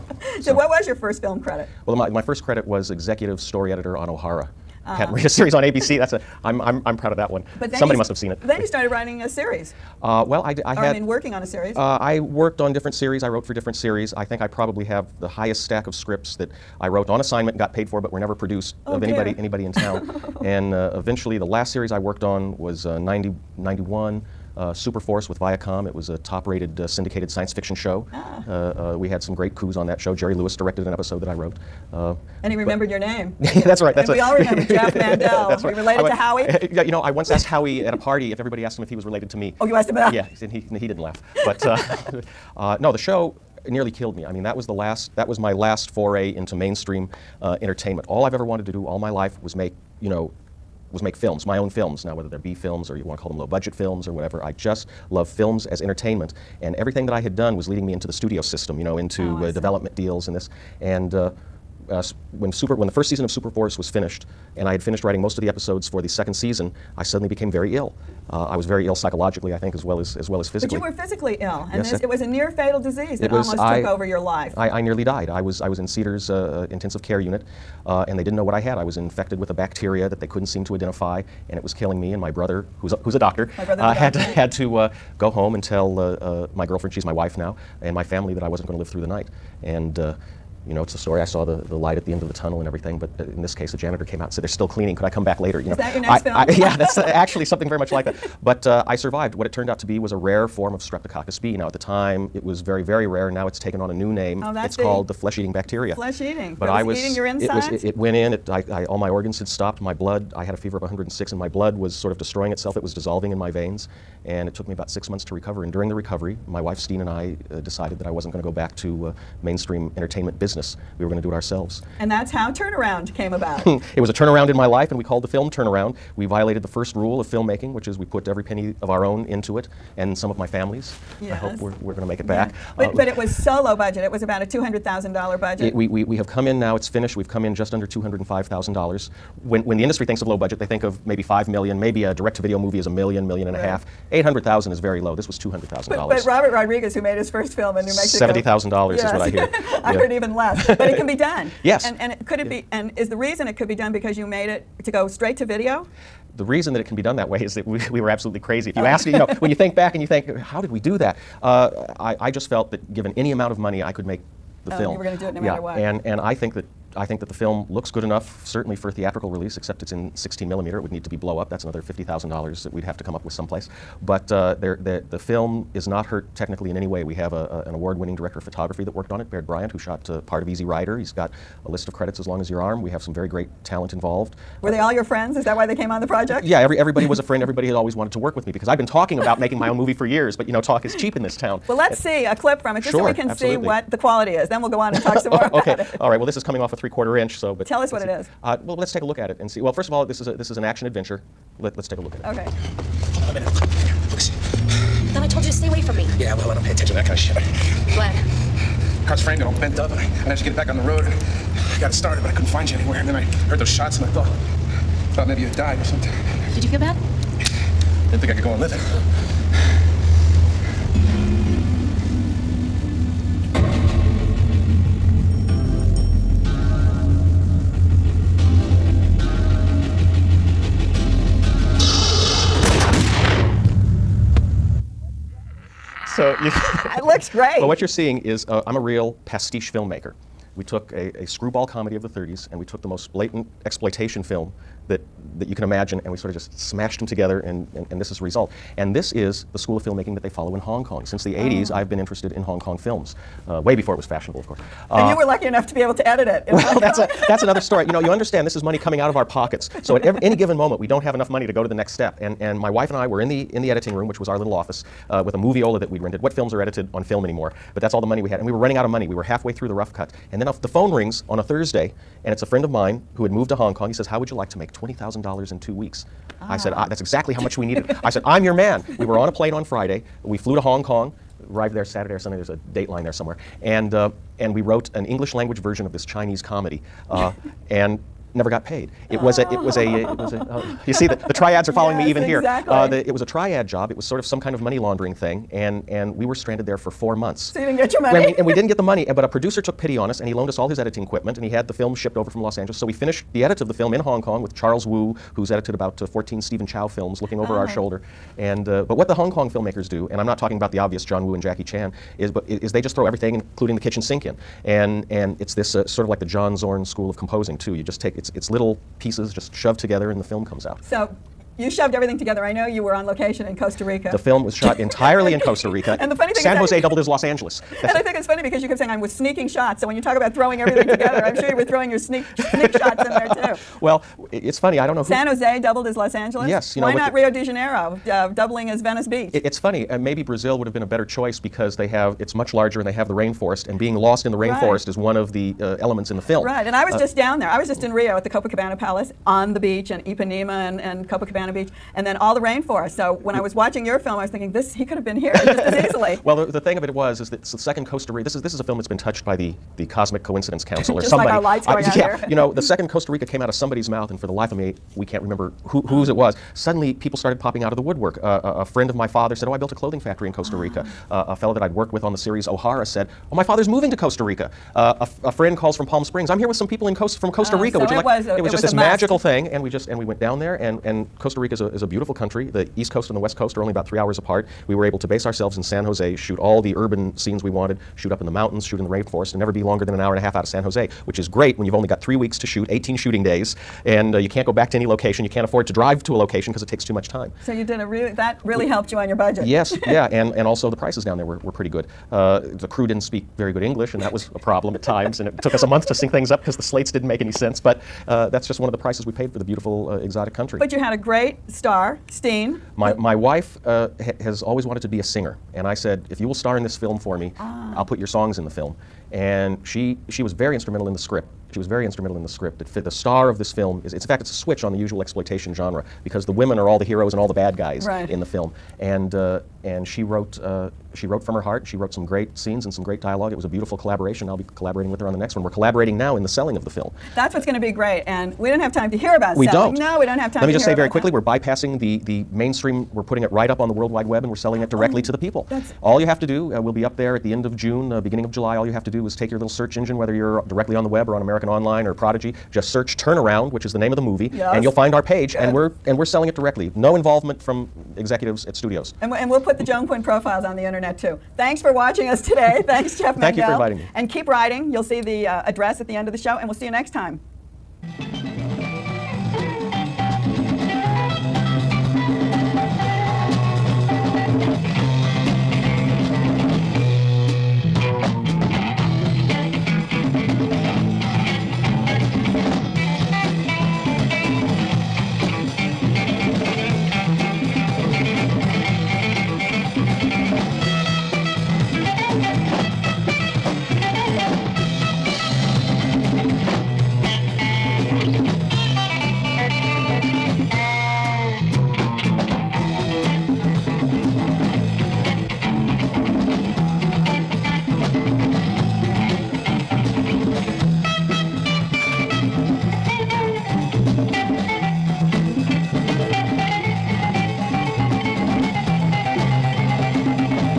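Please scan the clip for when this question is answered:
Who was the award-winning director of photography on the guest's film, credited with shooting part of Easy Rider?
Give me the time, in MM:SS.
02:59.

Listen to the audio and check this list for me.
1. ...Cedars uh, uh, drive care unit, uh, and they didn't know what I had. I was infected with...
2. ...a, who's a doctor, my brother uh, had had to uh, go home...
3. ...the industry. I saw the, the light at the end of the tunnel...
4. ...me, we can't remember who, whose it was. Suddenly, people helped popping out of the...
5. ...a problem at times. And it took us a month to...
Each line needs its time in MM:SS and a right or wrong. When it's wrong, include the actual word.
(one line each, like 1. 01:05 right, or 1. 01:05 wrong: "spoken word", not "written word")
1. 01:15 wrong: "intensive", not "drive"
2. 01:22 right
3. 01:30 wrong: "story", not "industry"
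4. 06:04 wrong: "started", not "helped"
5. 06:44 right.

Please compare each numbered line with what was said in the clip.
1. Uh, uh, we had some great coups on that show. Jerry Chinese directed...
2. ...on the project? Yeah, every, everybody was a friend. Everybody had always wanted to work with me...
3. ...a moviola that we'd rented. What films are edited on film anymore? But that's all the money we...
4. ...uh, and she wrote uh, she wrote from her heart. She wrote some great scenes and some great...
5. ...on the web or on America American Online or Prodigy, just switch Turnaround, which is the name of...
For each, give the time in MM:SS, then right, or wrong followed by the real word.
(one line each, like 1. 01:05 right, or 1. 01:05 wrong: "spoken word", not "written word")
1. 00:28 wrong: "Lewis", not "Chinese"
2. 03:05 right
3. 04:25 right
4. 07:09 right
5. 07:30 wrong: "search", not "switch".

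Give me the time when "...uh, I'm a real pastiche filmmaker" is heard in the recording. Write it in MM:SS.
03:58.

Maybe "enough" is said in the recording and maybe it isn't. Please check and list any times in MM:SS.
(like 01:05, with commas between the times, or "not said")
02:48, 04:15, 04:21.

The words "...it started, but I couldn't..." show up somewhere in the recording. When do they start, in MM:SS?
03:31.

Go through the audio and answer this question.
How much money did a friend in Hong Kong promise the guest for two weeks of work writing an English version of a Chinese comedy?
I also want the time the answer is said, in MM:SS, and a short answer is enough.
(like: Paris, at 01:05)
$20,000, at 04:34.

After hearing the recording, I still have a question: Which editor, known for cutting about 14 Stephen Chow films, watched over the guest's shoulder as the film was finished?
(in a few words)
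Charles Wu.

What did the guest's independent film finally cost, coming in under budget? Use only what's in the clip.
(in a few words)
$205,000.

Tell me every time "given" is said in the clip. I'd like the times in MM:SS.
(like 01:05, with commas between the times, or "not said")
02:42, 04:20.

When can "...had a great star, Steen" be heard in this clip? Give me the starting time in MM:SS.
06:50.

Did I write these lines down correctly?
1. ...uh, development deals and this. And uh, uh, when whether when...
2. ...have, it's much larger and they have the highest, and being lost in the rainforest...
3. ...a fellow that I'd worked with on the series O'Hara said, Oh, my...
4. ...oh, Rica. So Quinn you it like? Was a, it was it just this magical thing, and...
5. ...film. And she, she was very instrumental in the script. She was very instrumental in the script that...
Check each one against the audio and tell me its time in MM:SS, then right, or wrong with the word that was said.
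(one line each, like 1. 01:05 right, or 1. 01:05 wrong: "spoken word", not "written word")
1. 00:59 wrong: "super", not "whether"
2. 05:41 wrong: "rainforest", not "highest"
3. 06:11 right
4. 06:17 wrong: "Would", not "Quinn"
5. 06:58 right.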